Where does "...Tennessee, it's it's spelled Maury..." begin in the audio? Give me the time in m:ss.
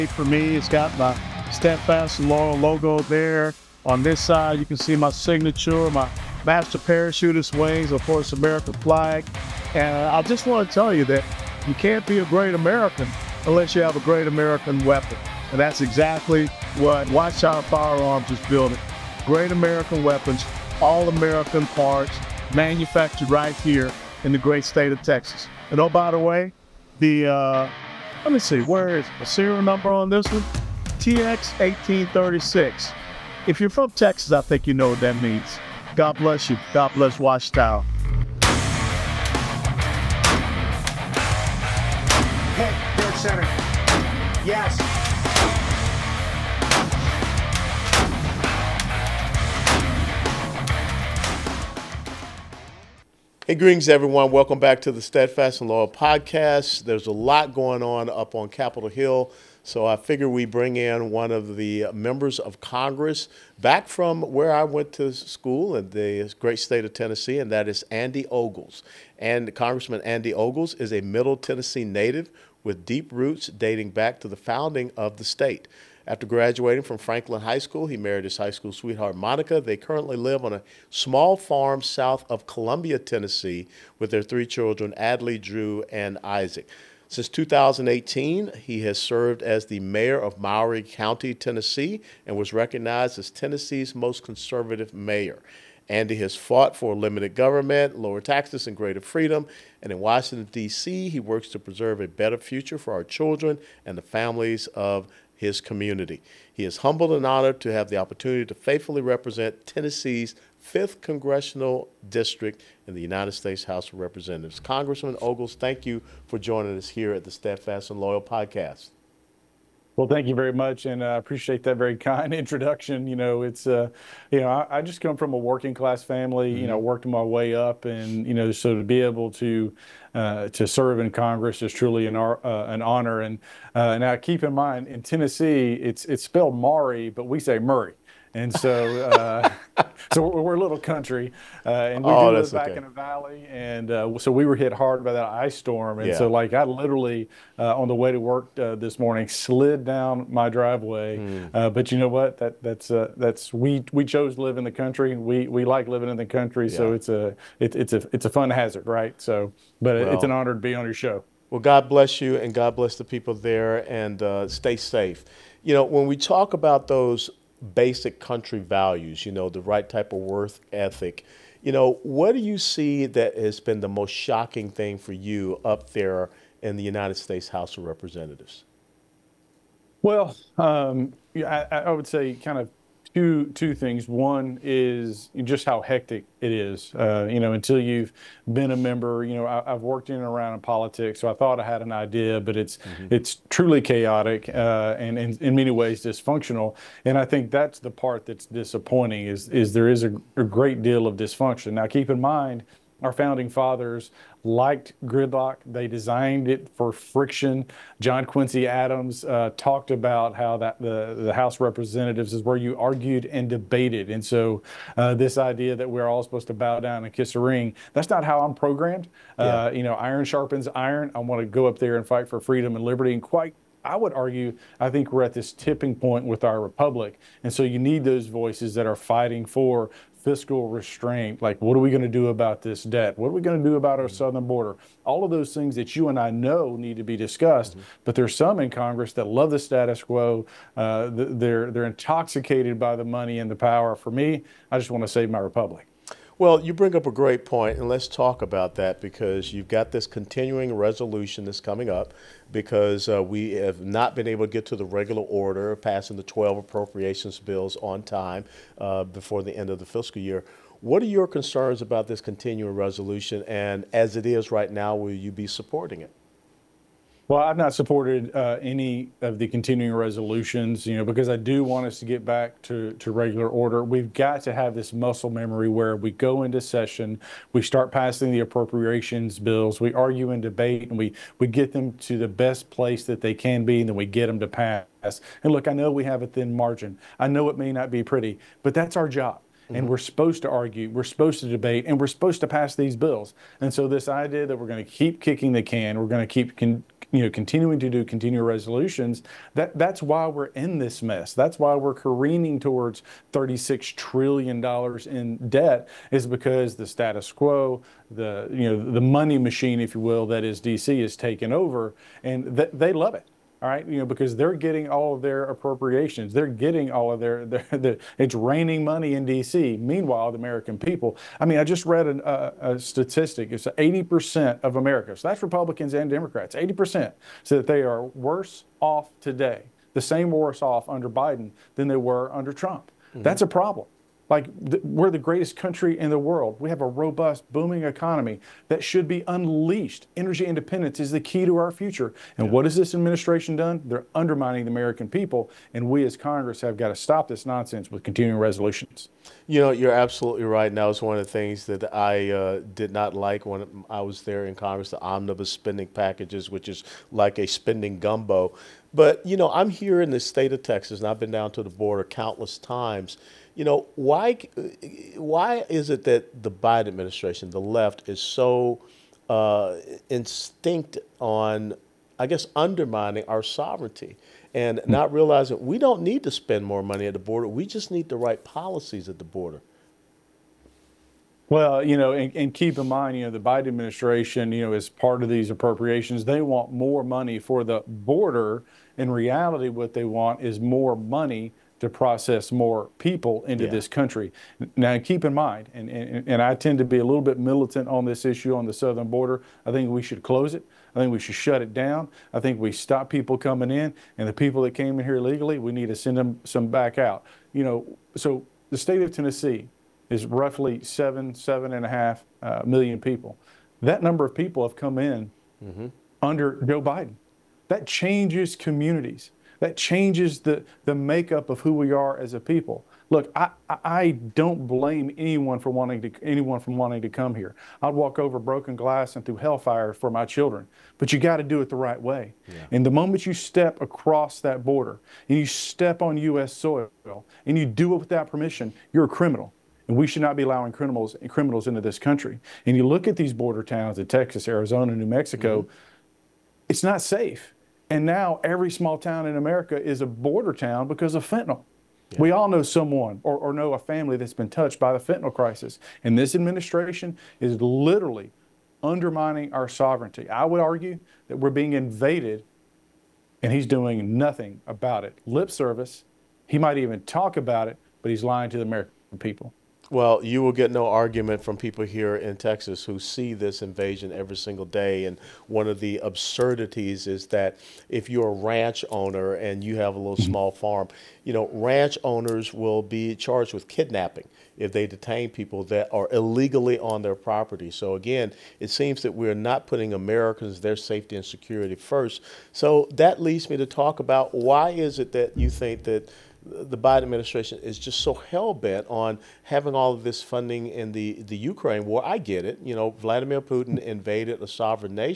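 2:15.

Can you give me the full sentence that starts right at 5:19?
Meanwhile, the American people, I mean, I just read an, uh, a statistic.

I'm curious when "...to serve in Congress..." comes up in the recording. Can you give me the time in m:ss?
2:10.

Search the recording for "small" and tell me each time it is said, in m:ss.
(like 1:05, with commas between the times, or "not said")
1:20, 7:28, 8:00.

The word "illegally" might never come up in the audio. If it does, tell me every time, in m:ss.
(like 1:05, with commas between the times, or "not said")
6:45, 8:06.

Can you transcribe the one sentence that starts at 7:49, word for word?
Well, you will get no argument from people here in Texas who see this invasion every single day.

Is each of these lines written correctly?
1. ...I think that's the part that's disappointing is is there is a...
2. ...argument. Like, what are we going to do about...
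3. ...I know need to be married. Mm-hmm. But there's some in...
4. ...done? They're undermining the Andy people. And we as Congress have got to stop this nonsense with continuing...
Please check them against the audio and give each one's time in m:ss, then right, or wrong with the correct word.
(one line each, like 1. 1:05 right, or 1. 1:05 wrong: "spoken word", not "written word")
1. 3:17 right
2. 3:50 wrong: "restraint", not "argument"
3. 3:56 wrong: "discussed", not "married"
4. 5:43 wrong: "American", not "Andy".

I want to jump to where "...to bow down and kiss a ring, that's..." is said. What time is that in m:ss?
3:36.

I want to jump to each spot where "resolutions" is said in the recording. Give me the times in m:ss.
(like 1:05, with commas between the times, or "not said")
4:10, 4:22, 4:29, 4:58, 5:48.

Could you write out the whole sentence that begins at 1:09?
And Congressman Andy Ogles is a Middle Tennessee native with deep roots dating back to the founding of the state.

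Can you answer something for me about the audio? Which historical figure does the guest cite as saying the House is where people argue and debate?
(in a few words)
John Quincy Adams.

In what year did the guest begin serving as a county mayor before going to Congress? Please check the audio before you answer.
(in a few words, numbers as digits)
2018.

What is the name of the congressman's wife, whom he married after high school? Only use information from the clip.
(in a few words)
Monica.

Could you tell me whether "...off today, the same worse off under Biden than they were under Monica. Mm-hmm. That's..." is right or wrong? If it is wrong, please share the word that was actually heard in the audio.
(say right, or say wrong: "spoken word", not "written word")
wrong: "Trump", not "Monica".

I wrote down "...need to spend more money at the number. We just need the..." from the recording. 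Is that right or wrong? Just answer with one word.
wrong.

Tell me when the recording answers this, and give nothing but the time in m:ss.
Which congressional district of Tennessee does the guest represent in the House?
1:50.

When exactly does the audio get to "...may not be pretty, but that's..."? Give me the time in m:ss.
4:47.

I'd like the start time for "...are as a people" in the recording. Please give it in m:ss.
7:01.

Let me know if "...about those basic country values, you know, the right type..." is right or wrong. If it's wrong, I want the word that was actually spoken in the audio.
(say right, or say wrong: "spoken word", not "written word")
right.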